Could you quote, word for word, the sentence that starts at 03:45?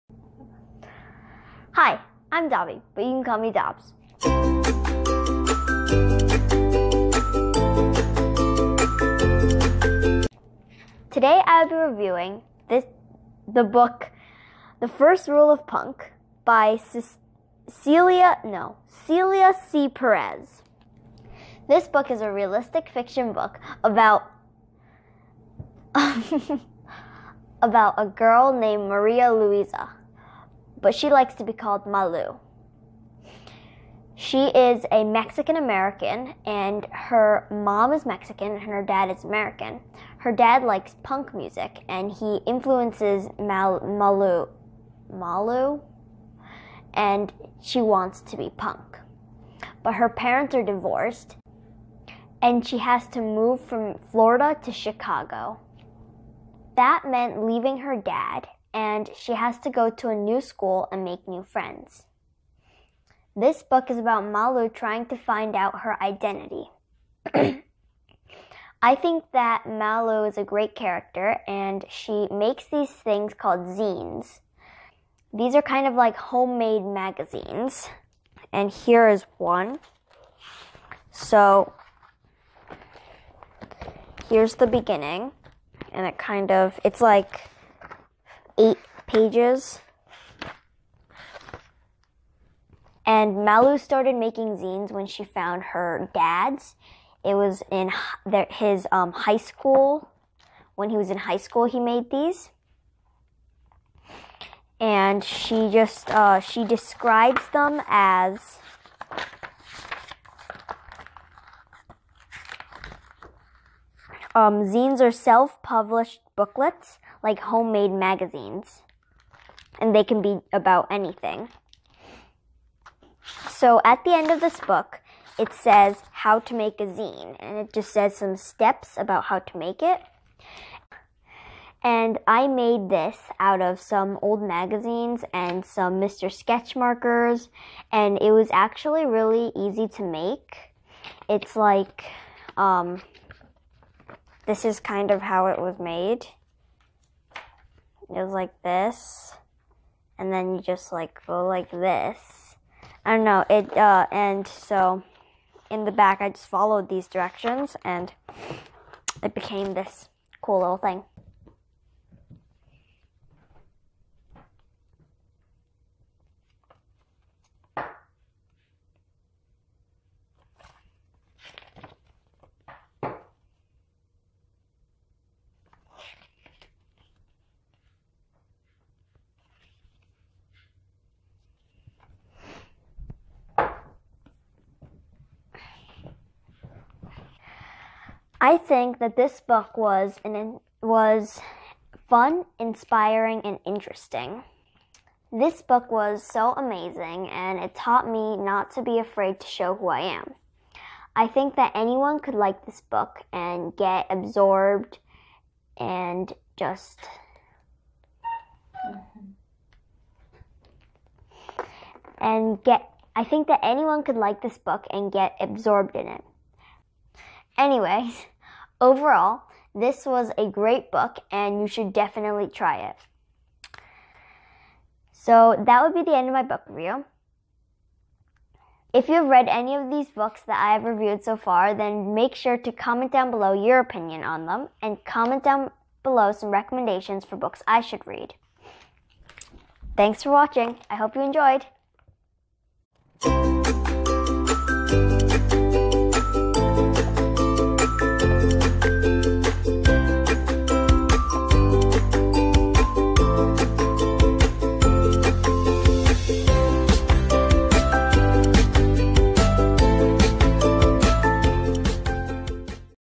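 So that would be the end of my book review.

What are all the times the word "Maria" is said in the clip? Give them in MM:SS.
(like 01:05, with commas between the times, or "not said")
00:28.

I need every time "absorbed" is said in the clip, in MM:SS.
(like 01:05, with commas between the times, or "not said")
03:24, 03:35.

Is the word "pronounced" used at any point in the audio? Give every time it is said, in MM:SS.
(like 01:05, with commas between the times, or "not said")
not said.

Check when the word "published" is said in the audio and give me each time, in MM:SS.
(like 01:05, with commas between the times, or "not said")
01:55.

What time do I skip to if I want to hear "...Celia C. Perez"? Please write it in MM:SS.
00:19.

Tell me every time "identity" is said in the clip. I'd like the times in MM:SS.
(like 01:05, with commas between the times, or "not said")
01:06.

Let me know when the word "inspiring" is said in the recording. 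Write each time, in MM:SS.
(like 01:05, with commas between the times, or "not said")
03:12.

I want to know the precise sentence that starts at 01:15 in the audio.
These are kind of like homemade magazines.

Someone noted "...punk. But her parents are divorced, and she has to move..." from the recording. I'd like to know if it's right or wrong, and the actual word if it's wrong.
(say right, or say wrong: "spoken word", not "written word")
right.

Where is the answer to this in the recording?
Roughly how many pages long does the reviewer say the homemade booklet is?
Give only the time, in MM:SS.
01:28.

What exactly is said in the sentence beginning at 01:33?
And Malu started making zines when she found her dad's.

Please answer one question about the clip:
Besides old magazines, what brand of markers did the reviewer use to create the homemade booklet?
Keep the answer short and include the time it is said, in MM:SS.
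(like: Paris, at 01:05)
Mr. Sketch, at 02:15.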